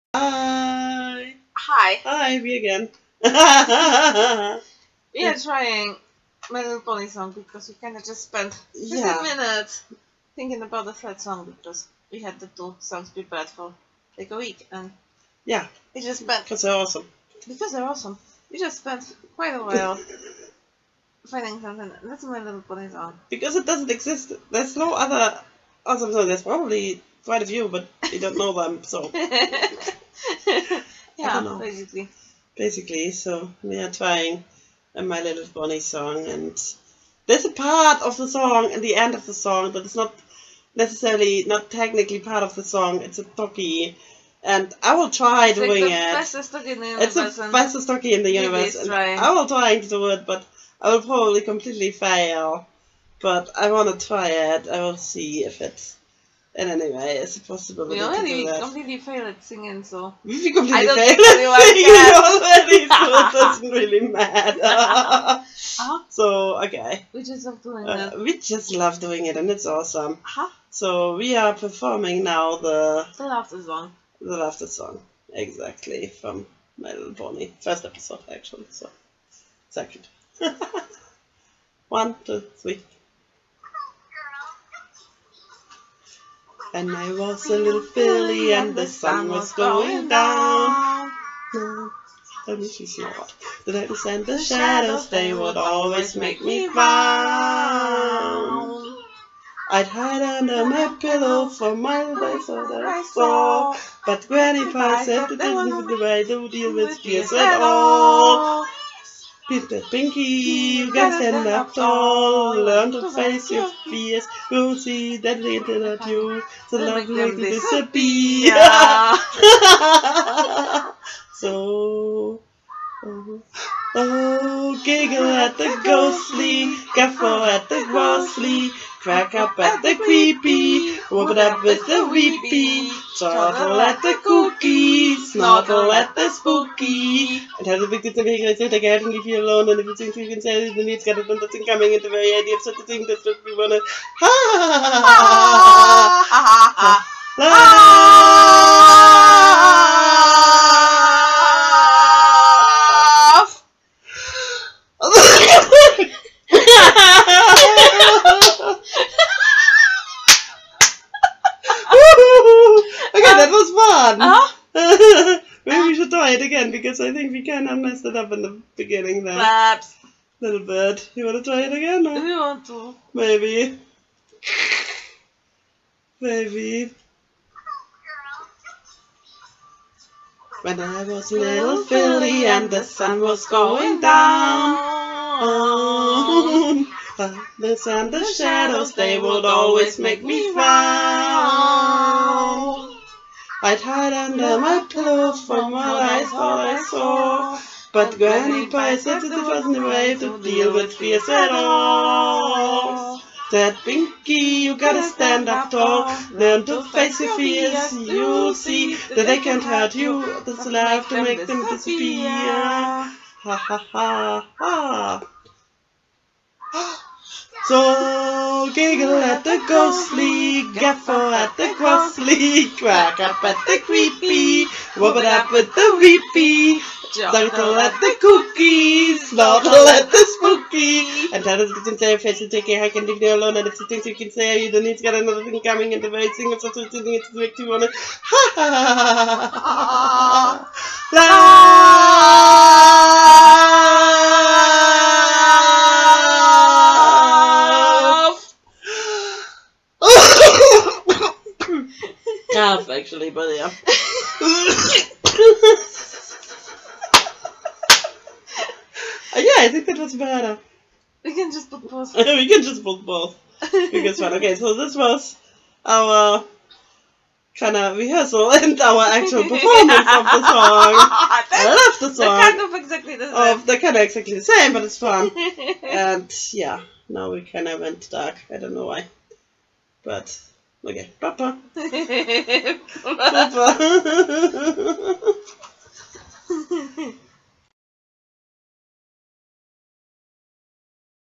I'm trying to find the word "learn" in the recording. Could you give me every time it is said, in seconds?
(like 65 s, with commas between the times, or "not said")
112 s, 206 s.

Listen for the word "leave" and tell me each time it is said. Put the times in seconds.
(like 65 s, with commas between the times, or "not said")
139 s, 233 s.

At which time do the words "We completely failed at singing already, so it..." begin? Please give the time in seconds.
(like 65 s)
60 s.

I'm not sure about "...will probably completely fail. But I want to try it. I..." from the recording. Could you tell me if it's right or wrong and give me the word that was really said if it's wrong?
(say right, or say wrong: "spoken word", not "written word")
right.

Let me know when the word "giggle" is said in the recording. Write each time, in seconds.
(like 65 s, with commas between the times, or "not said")
124 s, 218 s.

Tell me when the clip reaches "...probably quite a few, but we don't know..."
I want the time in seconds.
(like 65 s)
26 s.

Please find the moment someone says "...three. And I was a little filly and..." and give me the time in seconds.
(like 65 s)
82 s.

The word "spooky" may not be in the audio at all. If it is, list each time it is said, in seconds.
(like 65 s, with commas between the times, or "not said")
136 s, 230 s.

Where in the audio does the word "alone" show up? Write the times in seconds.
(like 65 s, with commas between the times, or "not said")
139 s, 233 s.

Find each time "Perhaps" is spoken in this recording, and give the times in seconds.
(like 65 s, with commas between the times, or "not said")
169 s.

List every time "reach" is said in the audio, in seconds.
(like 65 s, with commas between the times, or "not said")
not said.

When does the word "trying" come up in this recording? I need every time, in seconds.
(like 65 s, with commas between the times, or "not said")
5 s, 33 s.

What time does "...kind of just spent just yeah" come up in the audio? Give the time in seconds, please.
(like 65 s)
7 s.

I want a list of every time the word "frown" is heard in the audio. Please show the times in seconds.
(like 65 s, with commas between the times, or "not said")
96 s, 190 s.